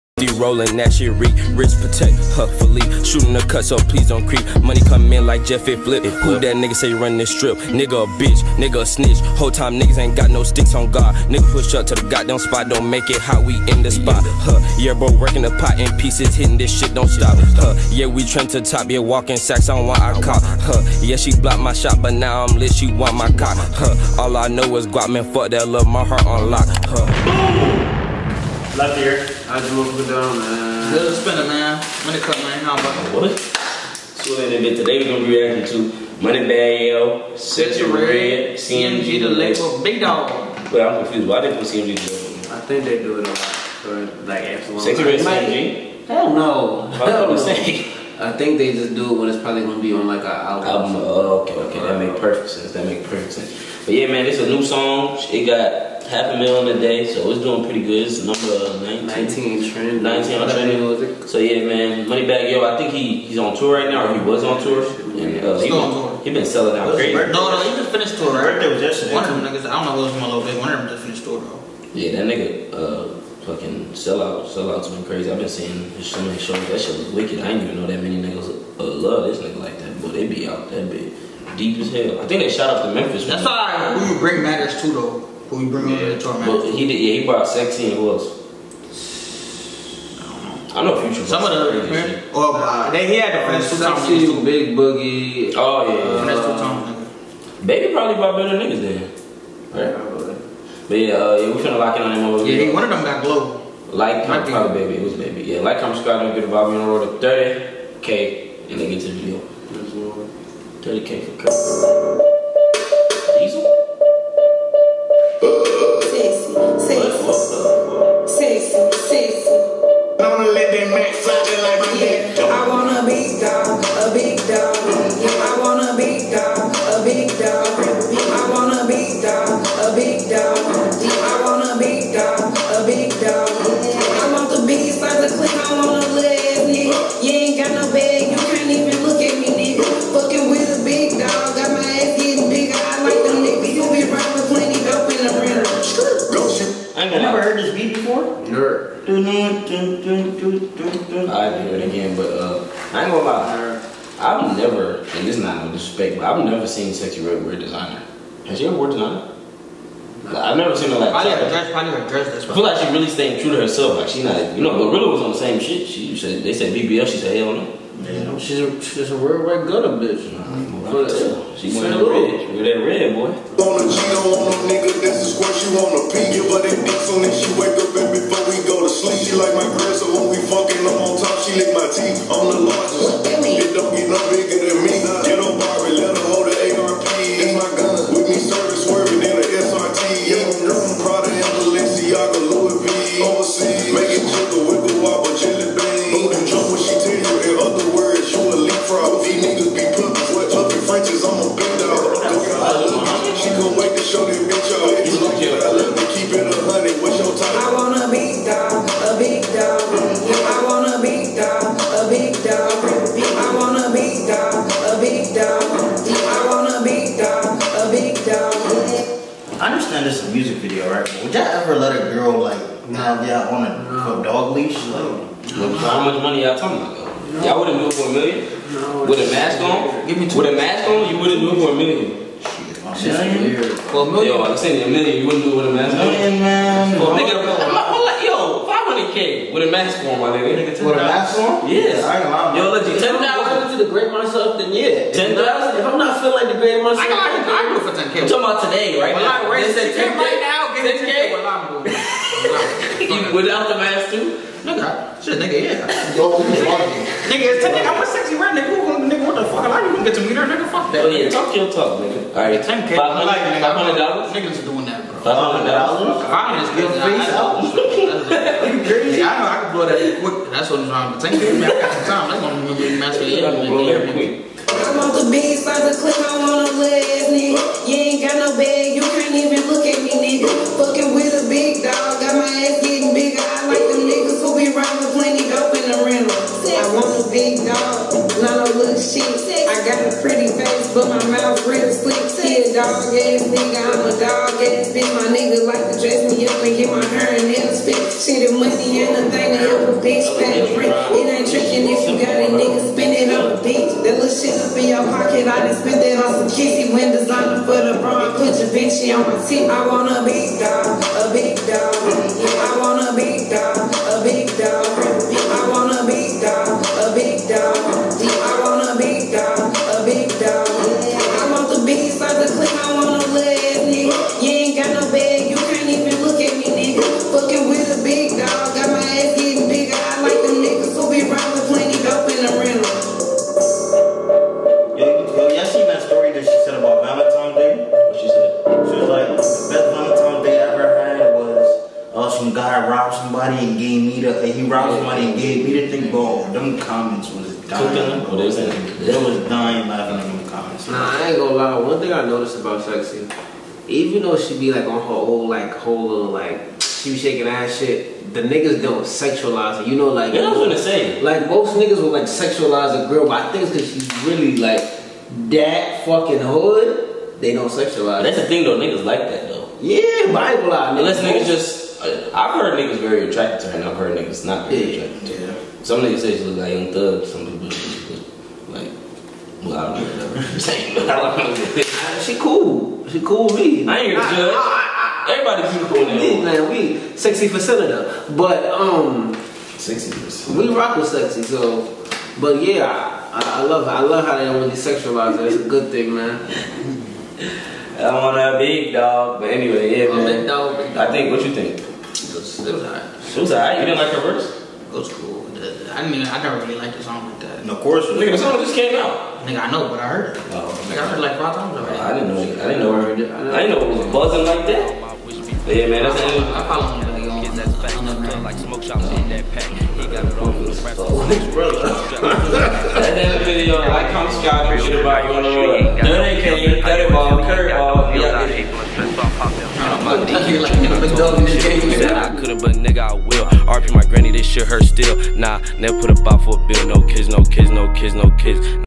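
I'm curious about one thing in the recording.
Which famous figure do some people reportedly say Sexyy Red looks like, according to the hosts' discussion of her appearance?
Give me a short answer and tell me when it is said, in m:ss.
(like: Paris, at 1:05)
Young Thug, at 6:16.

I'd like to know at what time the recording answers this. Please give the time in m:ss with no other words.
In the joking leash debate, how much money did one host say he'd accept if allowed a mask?
3:58.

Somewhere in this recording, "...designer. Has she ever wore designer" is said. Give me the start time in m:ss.
2:37.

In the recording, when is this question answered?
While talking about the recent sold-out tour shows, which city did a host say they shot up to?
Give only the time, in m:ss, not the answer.
1:22.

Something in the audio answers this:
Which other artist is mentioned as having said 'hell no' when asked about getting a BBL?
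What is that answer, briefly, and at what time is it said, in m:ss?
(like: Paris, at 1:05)
GloRilla, at 2:44.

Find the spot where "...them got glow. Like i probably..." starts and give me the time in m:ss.
1:42.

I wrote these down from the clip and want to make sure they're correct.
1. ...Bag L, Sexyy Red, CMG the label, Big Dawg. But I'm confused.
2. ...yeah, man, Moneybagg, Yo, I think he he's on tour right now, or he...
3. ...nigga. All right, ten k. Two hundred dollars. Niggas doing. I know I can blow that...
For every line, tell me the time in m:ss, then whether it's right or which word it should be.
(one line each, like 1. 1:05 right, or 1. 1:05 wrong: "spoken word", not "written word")
1. 0:36 right
2. 1:01 right
3. 4:21 wrong: "Five", not "Two".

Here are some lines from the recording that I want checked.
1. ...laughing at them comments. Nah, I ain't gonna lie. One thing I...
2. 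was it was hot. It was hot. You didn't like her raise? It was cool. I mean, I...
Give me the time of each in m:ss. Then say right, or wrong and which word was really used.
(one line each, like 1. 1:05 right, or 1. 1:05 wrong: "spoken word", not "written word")
1. 5:49 right
2. 6:42 wrong: "verse", not "raise".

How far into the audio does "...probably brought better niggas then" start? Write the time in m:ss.
1:37.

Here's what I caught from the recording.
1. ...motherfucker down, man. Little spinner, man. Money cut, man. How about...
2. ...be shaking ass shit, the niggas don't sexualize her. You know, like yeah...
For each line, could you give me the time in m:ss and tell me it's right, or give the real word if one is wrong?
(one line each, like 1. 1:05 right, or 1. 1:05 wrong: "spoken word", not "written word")
1. 0:29 right
2. 5:57 right.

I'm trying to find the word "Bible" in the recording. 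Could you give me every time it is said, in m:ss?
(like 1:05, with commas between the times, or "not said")
6:10.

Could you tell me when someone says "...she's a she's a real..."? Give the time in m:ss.
2:48.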